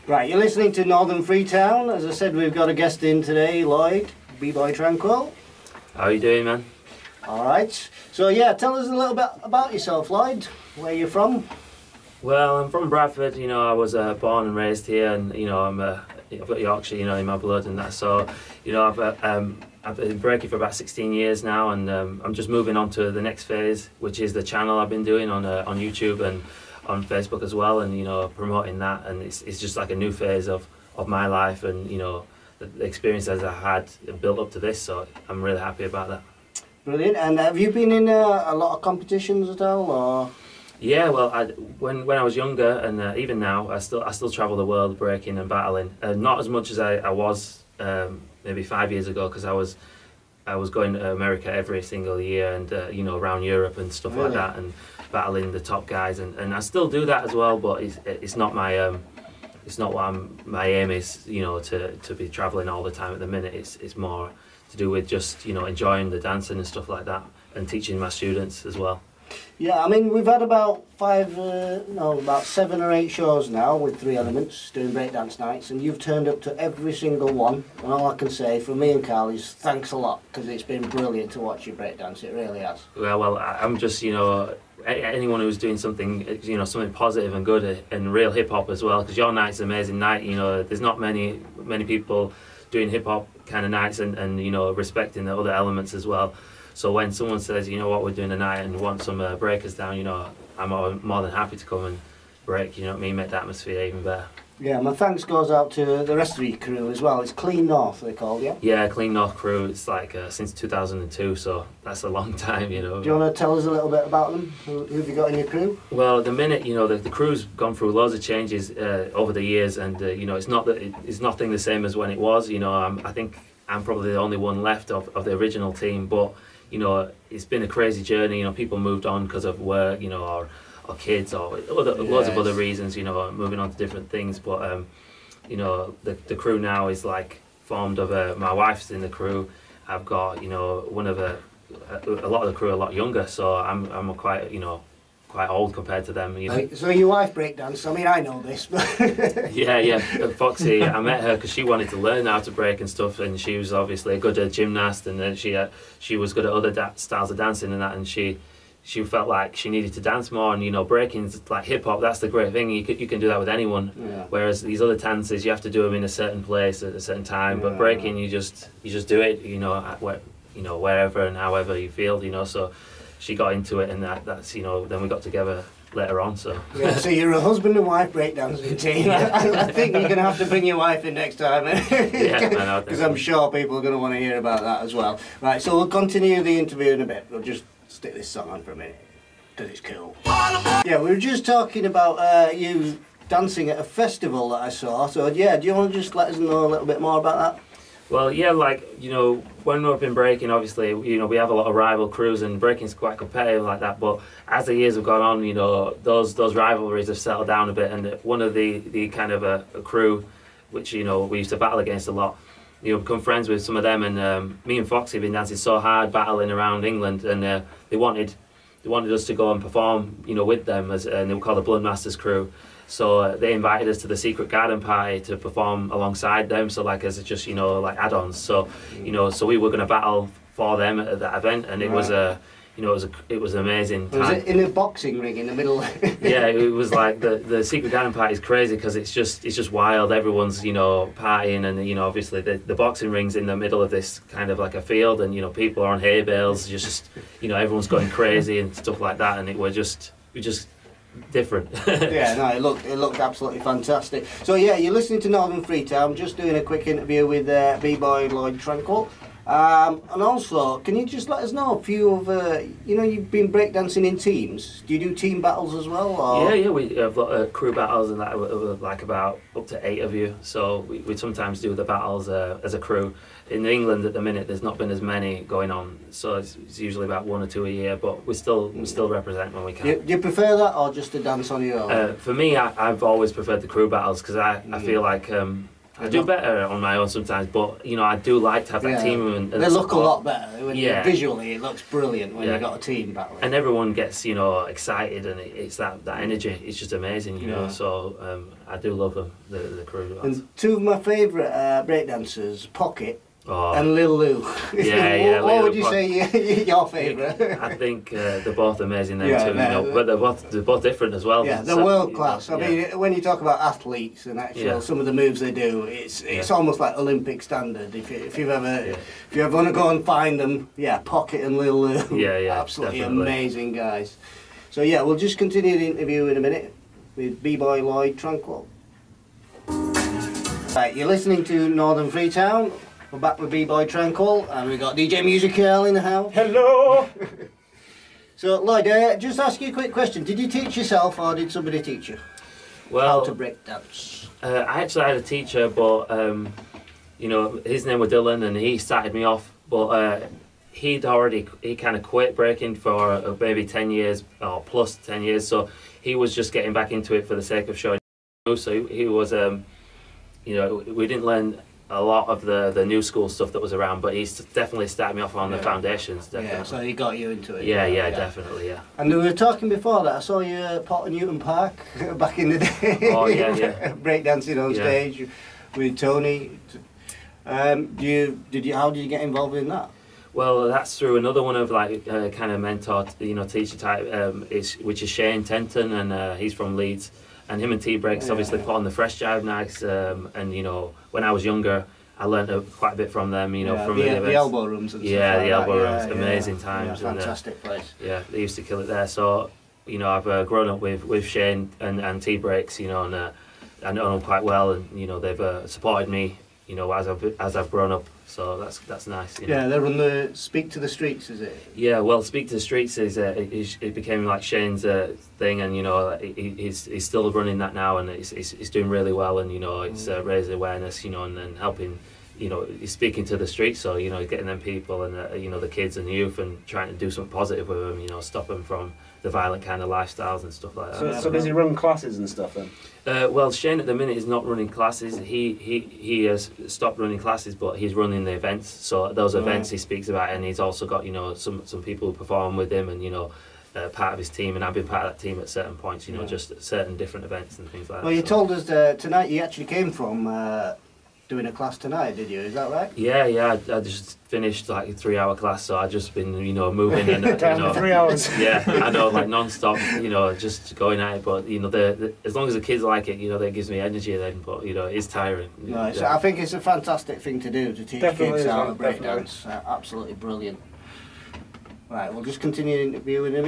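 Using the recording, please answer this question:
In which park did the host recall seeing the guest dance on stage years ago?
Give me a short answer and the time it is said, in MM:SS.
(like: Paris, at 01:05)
Potternewton Park, at 06:10.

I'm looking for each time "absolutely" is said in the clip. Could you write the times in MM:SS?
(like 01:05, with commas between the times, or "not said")
04:13, 05:22, 07:49.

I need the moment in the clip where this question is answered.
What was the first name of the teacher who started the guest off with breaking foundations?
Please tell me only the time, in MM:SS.
05:48.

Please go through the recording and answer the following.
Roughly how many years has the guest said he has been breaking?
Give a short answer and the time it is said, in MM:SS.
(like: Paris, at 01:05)
16 years, at 00:20.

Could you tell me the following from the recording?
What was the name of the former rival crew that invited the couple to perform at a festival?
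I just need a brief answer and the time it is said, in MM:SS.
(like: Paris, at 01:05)
Blood Masters Crew, at 03:41.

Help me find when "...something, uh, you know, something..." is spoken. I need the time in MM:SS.
01:25.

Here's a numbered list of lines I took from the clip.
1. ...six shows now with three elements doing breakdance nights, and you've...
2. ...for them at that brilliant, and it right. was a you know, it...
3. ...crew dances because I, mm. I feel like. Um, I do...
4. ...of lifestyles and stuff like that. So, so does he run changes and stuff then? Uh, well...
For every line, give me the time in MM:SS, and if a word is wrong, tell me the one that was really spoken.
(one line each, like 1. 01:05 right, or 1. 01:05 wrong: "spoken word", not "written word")
1. 01:12 wrong: "eight", not "six"
2. 03:50 wrong: "event", not "brilliant"
3. 04:43 wrong: "battles", not "dances"
4. 07:09 wrong: "classes", not "changes".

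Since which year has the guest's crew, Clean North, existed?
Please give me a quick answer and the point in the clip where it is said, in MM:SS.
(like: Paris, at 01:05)
2002, at 01:50.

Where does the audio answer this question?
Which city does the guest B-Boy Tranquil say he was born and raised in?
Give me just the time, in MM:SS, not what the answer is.
00:12.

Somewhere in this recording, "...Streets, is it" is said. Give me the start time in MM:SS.
06:50.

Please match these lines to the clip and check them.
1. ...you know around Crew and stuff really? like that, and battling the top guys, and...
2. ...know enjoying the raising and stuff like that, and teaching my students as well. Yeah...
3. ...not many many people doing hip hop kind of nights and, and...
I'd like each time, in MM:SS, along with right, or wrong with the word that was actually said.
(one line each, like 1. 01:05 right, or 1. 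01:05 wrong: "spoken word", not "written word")
1. 00:52 wrong: "Europe", not "Crew"
2. 01:05 wrong: "dancing", not "raising"
3. 01:30 right.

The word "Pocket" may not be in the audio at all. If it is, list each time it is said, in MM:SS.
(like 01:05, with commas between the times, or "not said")
05:02, 05:20.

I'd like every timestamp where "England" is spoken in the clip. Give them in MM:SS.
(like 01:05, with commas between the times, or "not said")
03:36, 04:33.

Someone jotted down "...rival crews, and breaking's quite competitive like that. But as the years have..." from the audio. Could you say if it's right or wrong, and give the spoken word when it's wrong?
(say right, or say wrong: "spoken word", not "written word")
right.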